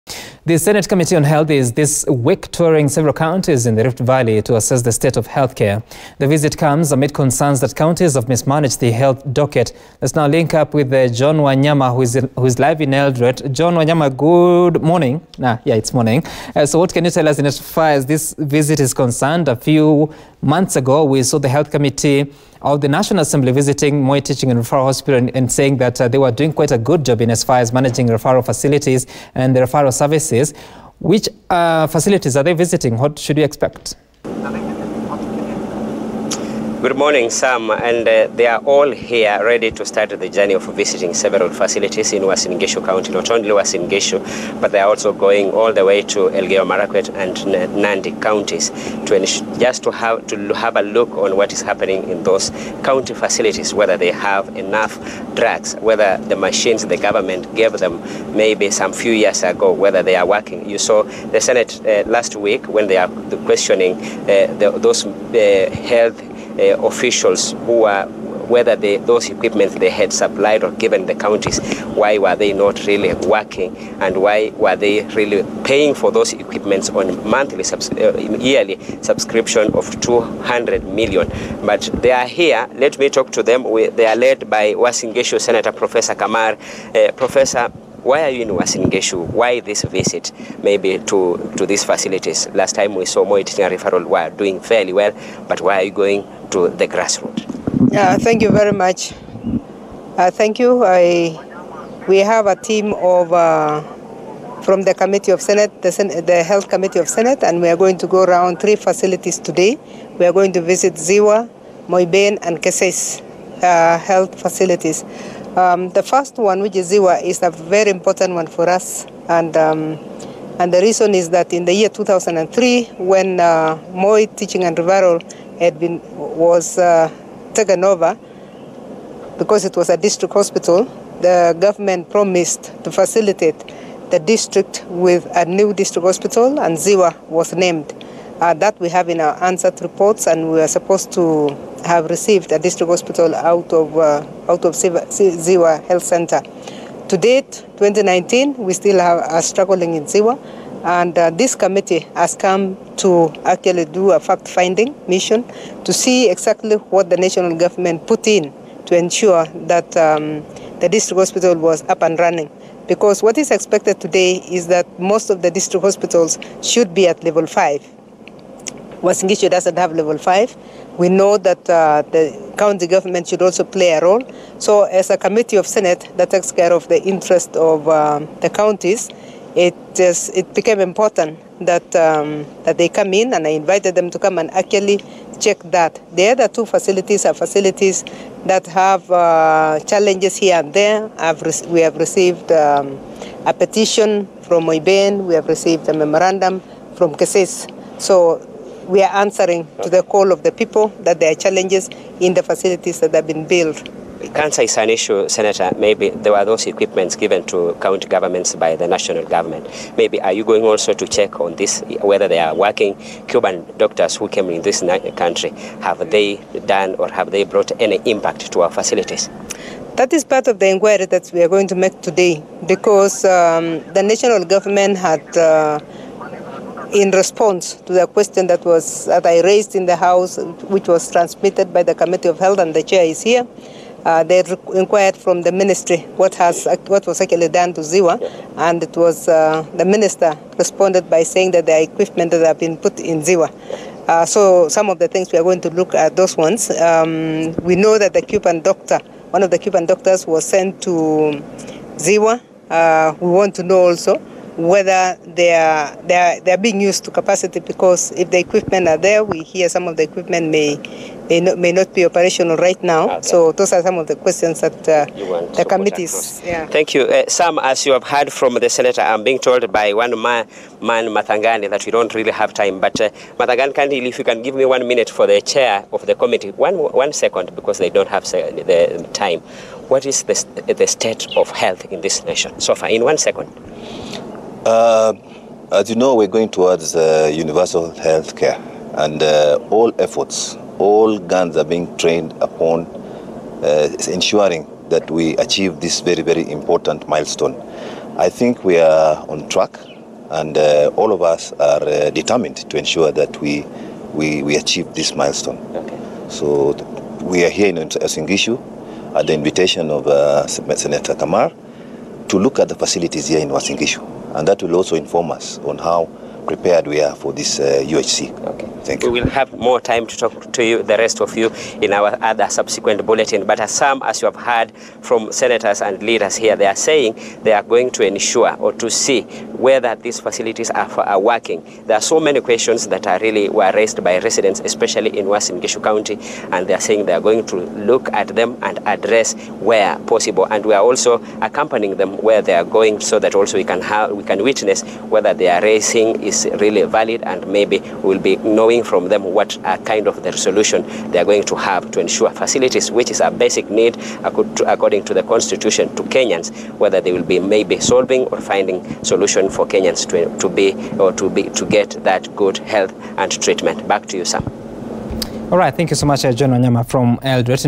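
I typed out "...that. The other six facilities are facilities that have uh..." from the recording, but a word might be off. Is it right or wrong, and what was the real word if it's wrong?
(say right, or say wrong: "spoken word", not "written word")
wrong: "two", not "six".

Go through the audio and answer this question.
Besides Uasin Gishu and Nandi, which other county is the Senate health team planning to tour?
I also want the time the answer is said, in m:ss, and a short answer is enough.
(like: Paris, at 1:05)
Elgeyo Marakwet, at 0:46.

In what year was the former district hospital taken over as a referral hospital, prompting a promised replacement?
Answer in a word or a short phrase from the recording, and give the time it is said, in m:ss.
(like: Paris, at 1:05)
2003, at 2:01.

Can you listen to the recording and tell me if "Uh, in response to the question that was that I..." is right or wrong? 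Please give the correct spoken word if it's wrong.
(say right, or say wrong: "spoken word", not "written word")
right.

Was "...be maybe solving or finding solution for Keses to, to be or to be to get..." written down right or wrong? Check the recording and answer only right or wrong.
wrong.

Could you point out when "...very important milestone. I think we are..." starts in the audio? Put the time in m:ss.
4:56.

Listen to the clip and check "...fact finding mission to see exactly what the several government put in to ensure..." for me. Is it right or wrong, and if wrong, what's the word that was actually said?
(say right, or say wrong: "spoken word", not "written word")
wrong: "national", not "several".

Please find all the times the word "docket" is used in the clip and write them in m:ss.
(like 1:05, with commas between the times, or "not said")
0:09.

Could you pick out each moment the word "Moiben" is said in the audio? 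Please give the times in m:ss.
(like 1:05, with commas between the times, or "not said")
1:51, 3:14.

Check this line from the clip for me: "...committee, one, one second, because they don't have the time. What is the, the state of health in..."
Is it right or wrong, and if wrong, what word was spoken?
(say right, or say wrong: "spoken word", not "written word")
right.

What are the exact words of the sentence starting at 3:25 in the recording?
Maybe there were those equipments given to county governments by the national government.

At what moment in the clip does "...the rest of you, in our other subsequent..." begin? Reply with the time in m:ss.
5:20.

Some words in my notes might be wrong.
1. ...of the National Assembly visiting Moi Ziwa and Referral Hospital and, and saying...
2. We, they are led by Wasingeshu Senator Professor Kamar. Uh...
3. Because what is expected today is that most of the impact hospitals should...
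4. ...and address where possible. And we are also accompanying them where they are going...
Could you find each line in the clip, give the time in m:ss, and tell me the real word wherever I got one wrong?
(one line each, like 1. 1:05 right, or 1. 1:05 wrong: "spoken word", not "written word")
1. 0:22 wrong: "Teaching", not "Ziwa"
2. 1:23 right
3. 2:42 wrong: "district", not "impact"
4. 5:38 right.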